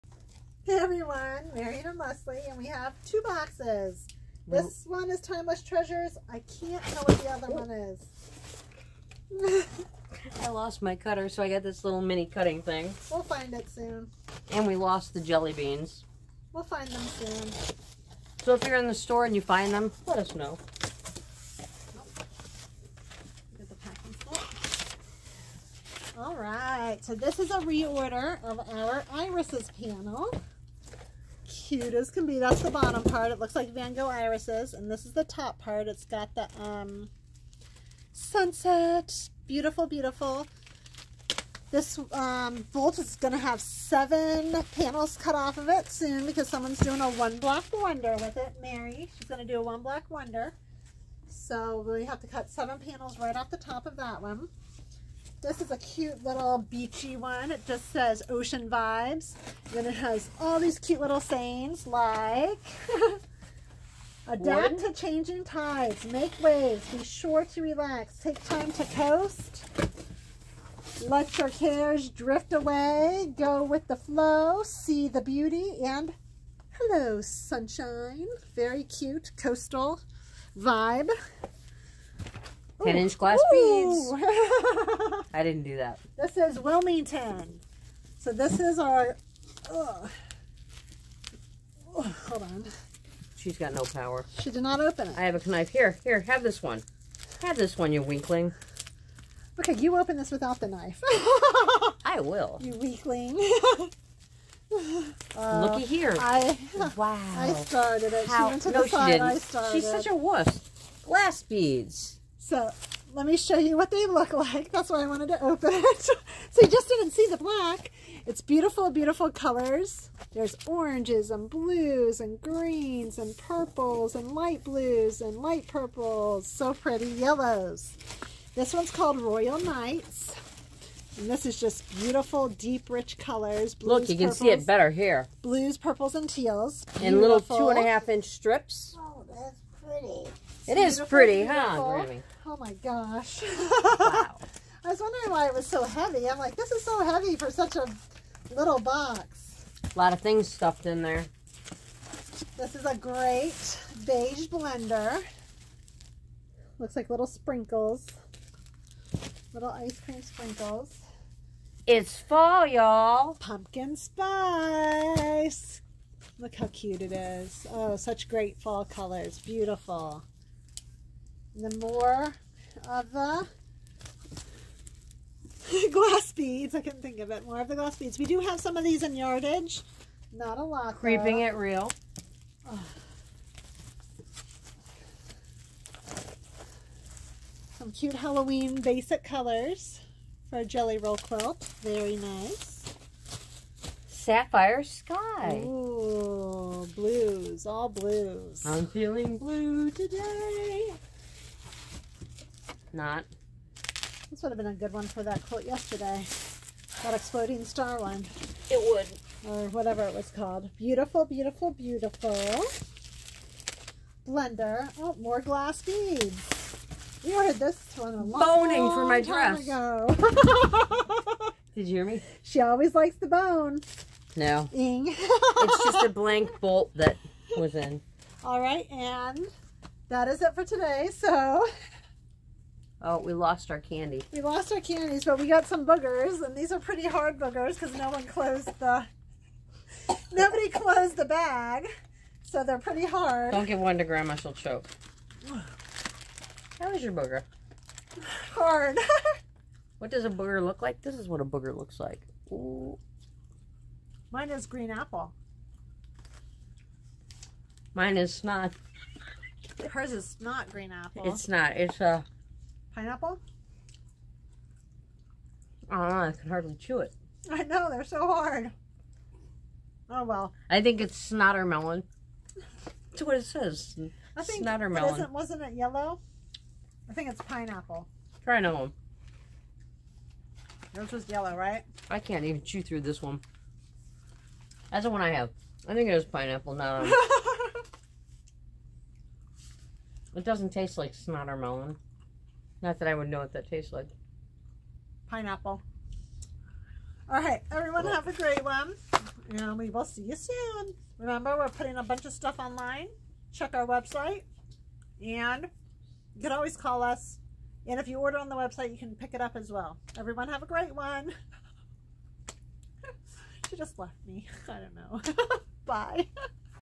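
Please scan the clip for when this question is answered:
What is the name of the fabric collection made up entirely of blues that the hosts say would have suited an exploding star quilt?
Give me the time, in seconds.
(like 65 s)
194 s.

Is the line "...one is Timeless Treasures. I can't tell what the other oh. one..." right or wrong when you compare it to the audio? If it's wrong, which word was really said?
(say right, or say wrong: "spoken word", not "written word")
right.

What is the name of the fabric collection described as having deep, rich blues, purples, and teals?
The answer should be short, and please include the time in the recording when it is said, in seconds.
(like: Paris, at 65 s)
Royal Knights, at 129 s.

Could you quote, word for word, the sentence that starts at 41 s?
This um, bolt is going to have seven panels cut off of it soon because someone's doing a one-block wonder with it.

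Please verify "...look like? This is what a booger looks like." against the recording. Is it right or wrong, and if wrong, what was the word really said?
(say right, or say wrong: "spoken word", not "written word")
right.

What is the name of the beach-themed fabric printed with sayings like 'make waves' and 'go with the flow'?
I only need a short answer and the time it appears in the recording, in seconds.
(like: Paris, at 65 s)
Ocean Vibes, at 58 s.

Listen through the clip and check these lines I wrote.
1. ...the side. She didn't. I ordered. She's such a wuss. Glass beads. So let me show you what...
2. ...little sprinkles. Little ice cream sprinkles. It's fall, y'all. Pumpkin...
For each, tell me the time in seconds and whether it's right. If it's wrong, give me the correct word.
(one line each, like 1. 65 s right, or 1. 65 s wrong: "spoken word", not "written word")
1. 108 s wrong: "started", not "ordered"
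2. 157 s right.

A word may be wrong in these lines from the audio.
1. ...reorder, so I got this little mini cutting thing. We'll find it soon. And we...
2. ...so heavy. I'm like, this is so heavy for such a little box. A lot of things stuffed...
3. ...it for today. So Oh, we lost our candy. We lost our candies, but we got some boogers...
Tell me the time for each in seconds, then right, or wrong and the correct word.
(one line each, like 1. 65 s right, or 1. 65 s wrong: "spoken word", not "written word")
1. 10 s wrong: "cutter", not "reorder"
2. 145 s right
3. 230 s right.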